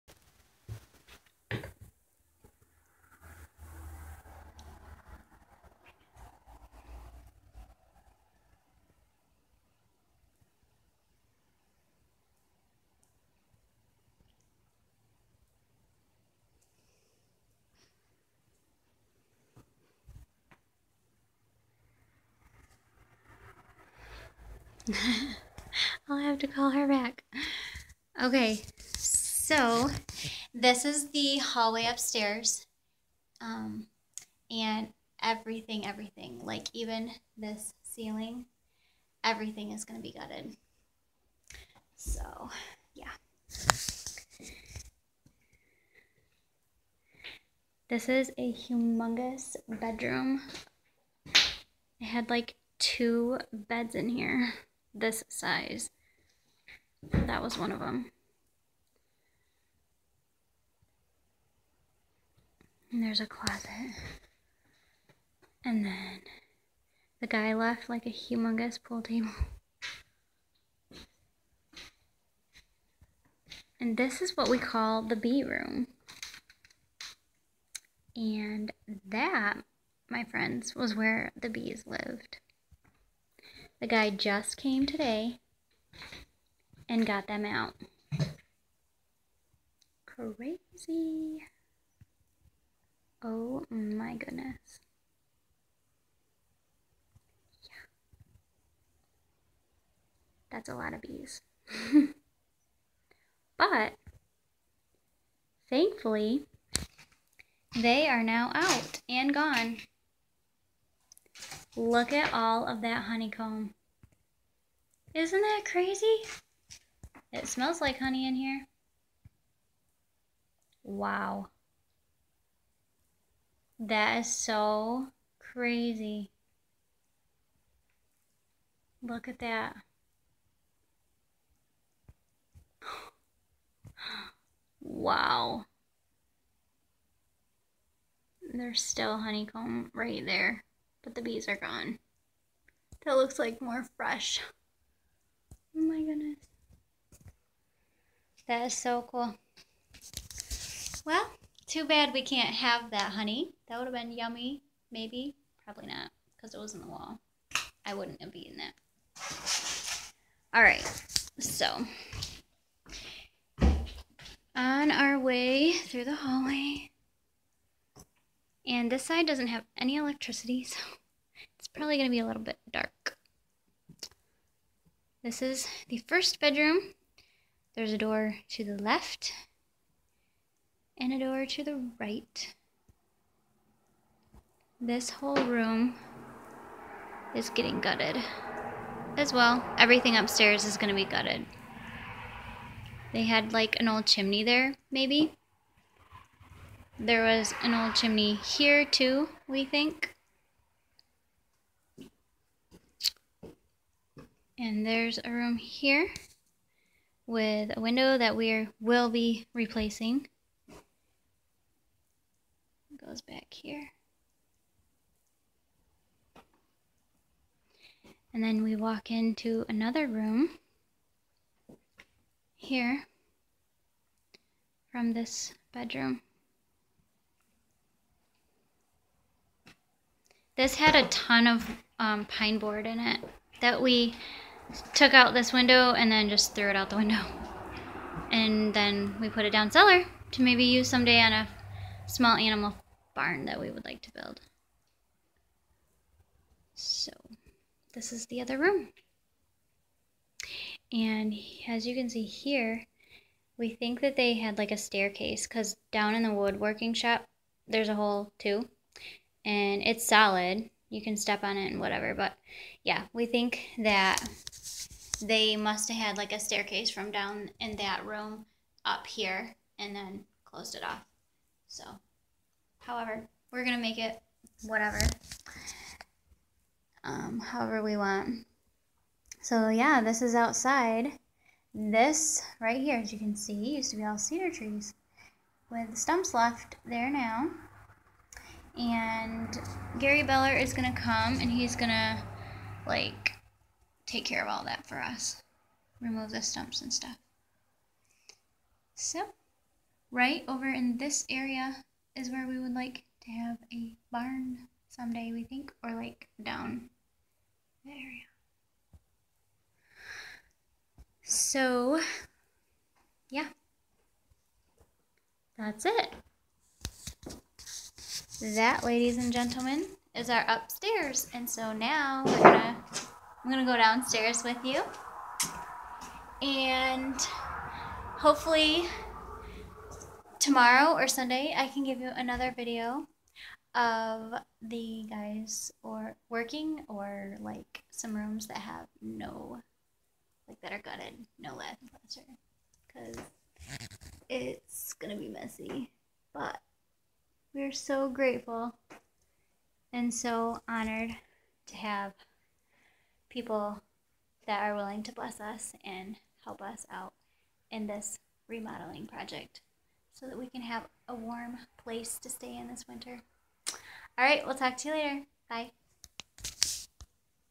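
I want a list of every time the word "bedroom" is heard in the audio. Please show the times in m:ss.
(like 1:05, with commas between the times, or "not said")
0:49, 2:56, 3:45.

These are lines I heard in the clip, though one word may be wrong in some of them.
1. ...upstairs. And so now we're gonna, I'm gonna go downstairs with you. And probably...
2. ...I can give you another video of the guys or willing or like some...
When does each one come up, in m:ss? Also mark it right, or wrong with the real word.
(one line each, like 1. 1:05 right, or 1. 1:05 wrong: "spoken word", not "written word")
1. 5:20 wrong: "hopefully", not "probably"
2. 5:31 wrong: "working", not "willing".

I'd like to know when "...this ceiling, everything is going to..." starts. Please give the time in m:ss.
0:37.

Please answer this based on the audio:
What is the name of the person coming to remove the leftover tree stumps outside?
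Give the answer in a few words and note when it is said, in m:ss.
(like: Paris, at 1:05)
Gary Beller, at 4:49.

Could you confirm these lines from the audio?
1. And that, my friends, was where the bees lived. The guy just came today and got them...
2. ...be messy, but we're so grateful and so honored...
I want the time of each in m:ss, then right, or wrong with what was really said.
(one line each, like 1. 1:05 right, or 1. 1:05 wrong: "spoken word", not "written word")
1. 1:18 right
2. 5:45 right.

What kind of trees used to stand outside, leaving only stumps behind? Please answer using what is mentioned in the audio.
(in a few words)
cedar trees.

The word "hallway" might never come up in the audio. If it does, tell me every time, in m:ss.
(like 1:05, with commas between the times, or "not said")
0:31, 2:46.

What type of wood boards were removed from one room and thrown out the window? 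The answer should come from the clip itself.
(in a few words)
pine board.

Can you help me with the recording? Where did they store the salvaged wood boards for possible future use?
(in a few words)
down cellar.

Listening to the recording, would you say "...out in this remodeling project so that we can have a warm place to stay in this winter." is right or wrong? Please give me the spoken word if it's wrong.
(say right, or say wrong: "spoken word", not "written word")
right.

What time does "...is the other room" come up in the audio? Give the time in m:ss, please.
4:08.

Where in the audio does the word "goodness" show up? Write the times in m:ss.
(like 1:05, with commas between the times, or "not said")
1:34, 2:26.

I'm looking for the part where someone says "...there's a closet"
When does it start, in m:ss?
1:03.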